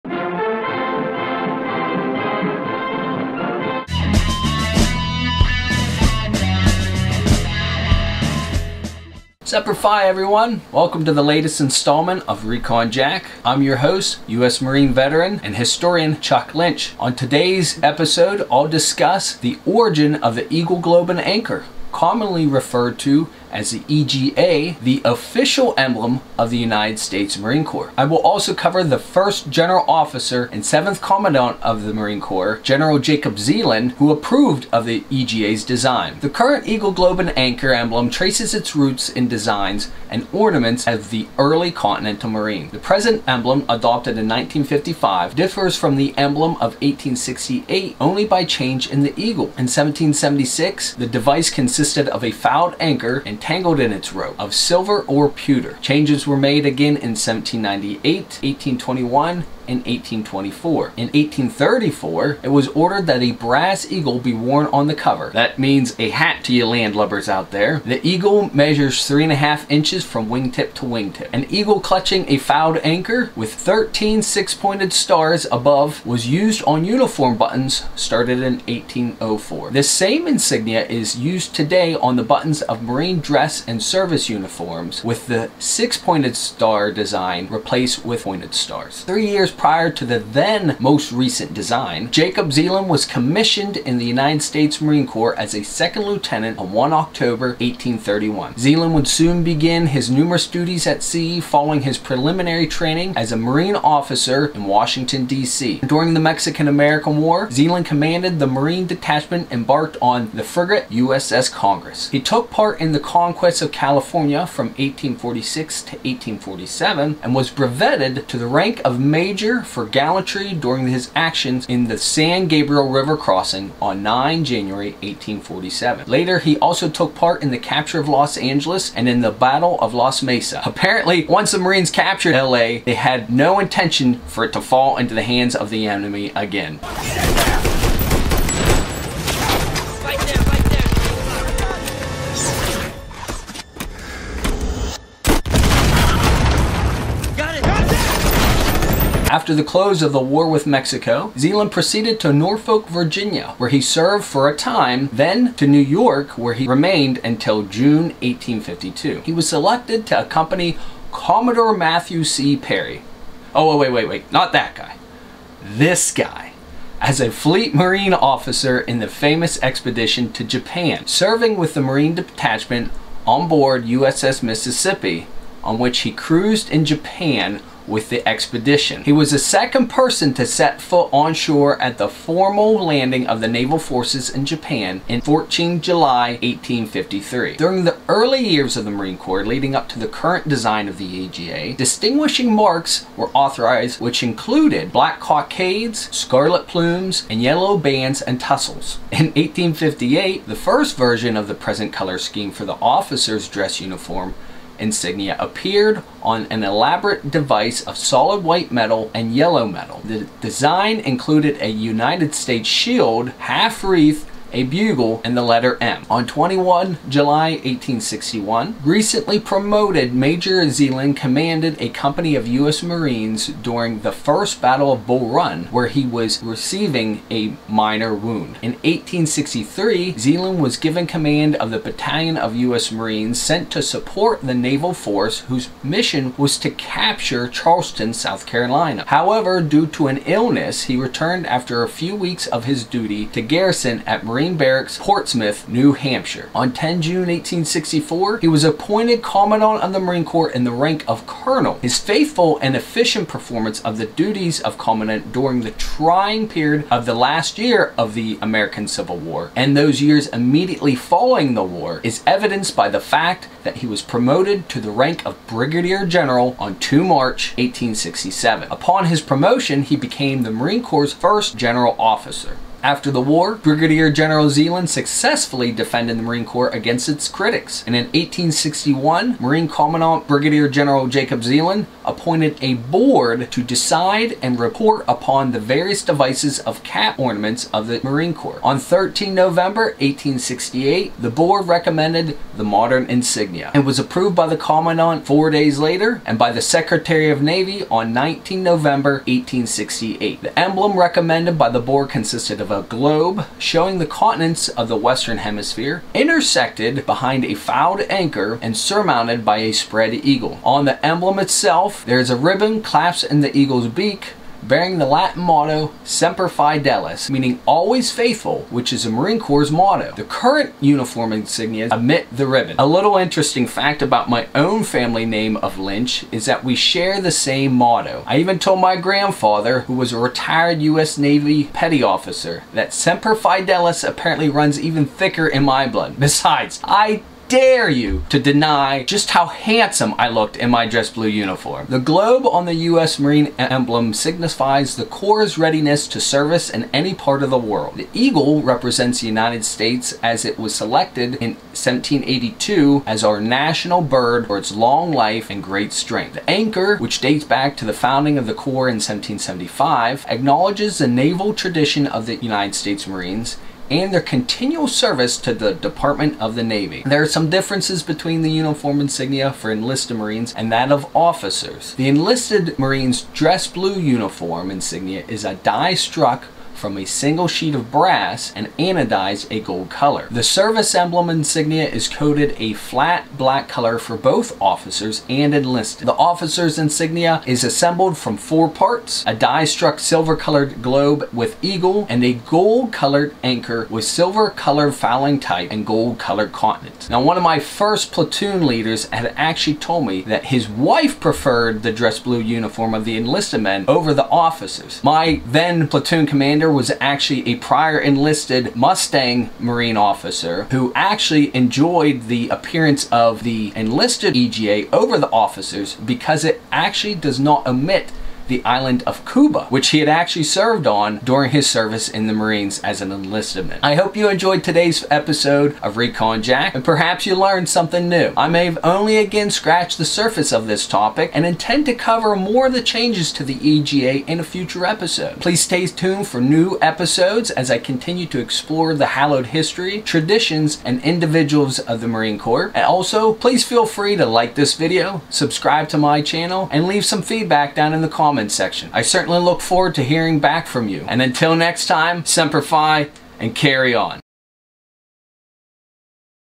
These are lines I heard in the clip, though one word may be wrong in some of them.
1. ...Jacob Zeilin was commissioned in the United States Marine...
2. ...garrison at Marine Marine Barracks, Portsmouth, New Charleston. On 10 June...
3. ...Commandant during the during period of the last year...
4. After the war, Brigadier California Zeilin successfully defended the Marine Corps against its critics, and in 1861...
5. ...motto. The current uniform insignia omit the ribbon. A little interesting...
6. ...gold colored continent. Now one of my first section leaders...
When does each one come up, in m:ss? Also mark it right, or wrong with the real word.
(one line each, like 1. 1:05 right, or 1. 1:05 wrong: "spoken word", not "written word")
1. 1:32 right
2. 4:03 wrong: "Hampshire", not "Charleston"
3. 4:14 wrong: "trying", not "during"
4. 4:32 wrong: "General", not "California"
5. 5:19 right
6. 6:35 wrong: "platoon", not "section".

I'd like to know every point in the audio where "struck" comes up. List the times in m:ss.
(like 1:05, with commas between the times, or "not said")
6:15, 6:29.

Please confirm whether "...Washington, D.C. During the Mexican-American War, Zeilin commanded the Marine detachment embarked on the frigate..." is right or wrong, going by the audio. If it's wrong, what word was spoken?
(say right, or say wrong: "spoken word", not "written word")
right.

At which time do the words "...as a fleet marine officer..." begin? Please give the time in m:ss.
2:46.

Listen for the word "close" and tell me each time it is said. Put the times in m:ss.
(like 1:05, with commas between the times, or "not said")
2:29.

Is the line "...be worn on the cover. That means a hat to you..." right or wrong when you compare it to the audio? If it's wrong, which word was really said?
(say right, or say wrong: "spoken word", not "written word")
right.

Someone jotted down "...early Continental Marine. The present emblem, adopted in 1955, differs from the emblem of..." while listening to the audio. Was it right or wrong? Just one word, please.
right.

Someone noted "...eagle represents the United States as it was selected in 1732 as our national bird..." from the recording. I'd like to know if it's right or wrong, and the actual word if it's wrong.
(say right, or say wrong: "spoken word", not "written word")
wrong: "1782", not "1732".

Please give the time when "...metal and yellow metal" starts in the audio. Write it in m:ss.
3:28.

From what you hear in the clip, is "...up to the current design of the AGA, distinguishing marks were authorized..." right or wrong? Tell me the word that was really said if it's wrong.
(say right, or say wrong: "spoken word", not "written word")
right.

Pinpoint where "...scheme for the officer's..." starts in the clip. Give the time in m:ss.
3:22.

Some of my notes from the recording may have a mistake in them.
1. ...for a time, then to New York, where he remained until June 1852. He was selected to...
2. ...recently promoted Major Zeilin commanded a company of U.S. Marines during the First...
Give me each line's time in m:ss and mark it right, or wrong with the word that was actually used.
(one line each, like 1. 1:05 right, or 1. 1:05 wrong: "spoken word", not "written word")
1. 2:34 right
2. 3:38 right.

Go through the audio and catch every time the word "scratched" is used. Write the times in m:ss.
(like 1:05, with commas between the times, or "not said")
7:09.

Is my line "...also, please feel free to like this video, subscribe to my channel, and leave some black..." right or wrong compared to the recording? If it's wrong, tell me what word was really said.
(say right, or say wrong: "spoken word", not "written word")
wrong: "feedback", not "black".